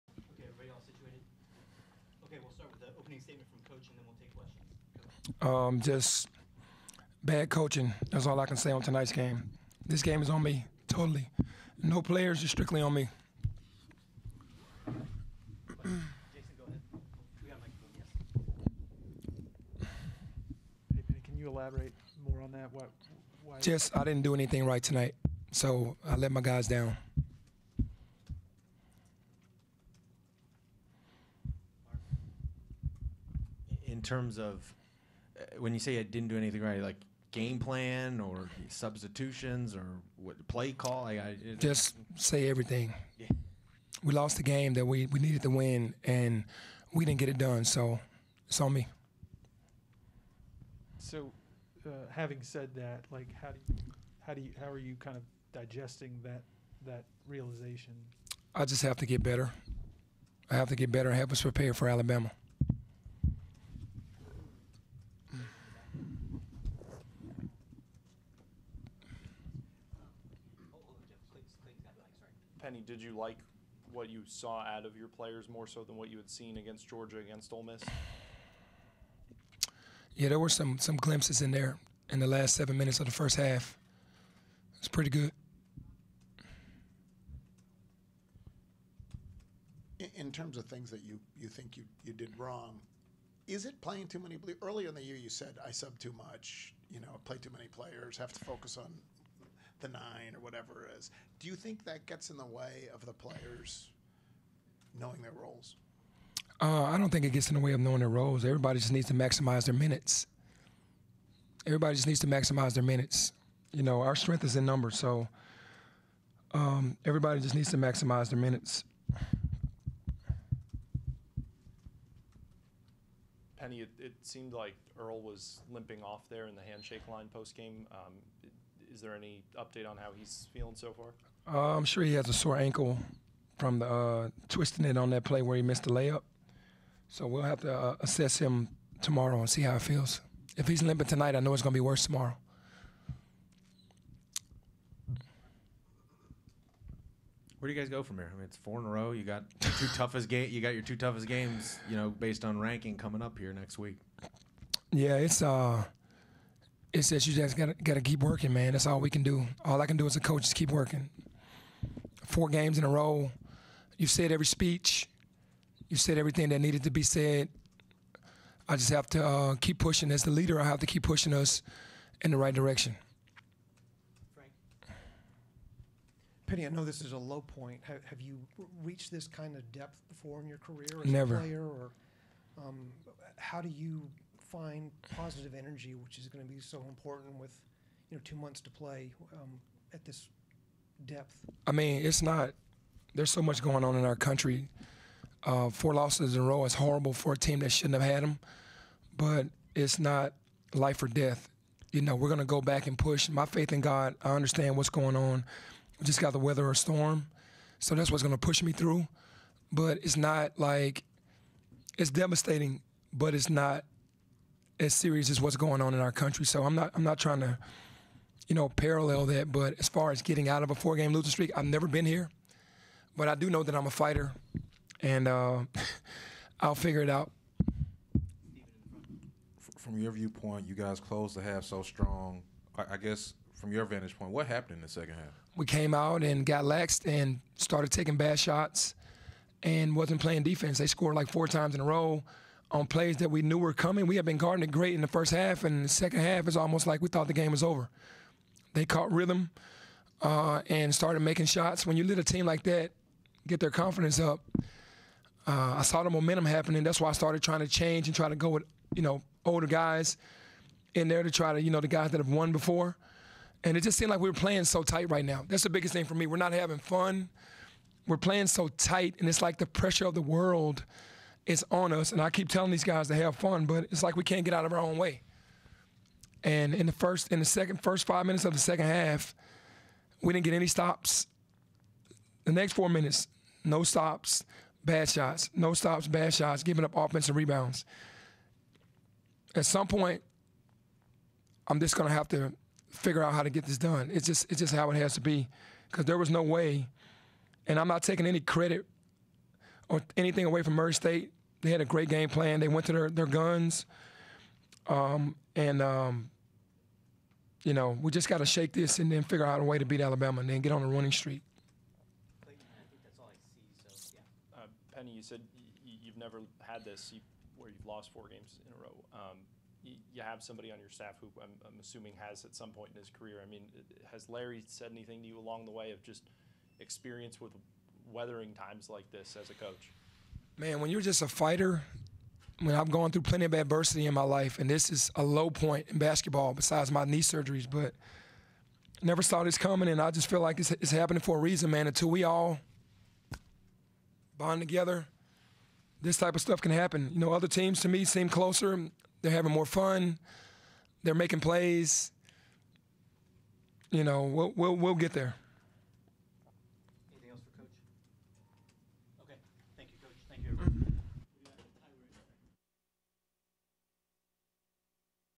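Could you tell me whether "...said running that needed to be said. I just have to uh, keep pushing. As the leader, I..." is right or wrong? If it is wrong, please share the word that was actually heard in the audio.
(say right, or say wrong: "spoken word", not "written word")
wrong: "everything", not "running".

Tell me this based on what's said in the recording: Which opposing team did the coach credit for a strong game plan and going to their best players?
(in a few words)
Murray State.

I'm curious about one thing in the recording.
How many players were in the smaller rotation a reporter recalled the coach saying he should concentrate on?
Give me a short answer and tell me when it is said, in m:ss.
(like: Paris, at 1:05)
9, at 1:39.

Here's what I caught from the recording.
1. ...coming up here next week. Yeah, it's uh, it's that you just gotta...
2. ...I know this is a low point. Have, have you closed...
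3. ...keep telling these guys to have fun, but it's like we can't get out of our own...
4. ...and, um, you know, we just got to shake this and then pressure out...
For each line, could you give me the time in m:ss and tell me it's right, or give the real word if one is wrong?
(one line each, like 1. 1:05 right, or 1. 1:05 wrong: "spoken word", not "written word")
1. 2:32 right
2. 2:56 wrong: "reached", not "closed"
3. 4:32 right
4. 5:05 wrong: "figure", not "pressure".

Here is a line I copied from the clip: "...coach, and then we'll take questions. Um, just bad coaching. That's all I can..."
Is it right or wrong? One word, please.
right.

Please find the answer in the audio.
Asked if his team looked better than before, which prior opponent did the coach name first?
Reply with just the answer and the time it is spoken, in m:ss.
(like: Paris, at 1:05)
Georgia, at 1:16.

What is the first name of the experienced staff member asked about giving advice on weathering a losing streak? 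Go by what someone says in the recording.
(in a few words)
Larry.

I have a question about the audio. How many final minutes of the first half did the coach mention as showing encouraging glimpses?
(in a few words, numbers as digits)
7.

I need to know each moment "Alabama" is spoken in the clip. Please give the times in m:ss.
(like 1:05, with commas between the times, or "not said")
1:01, 5:10.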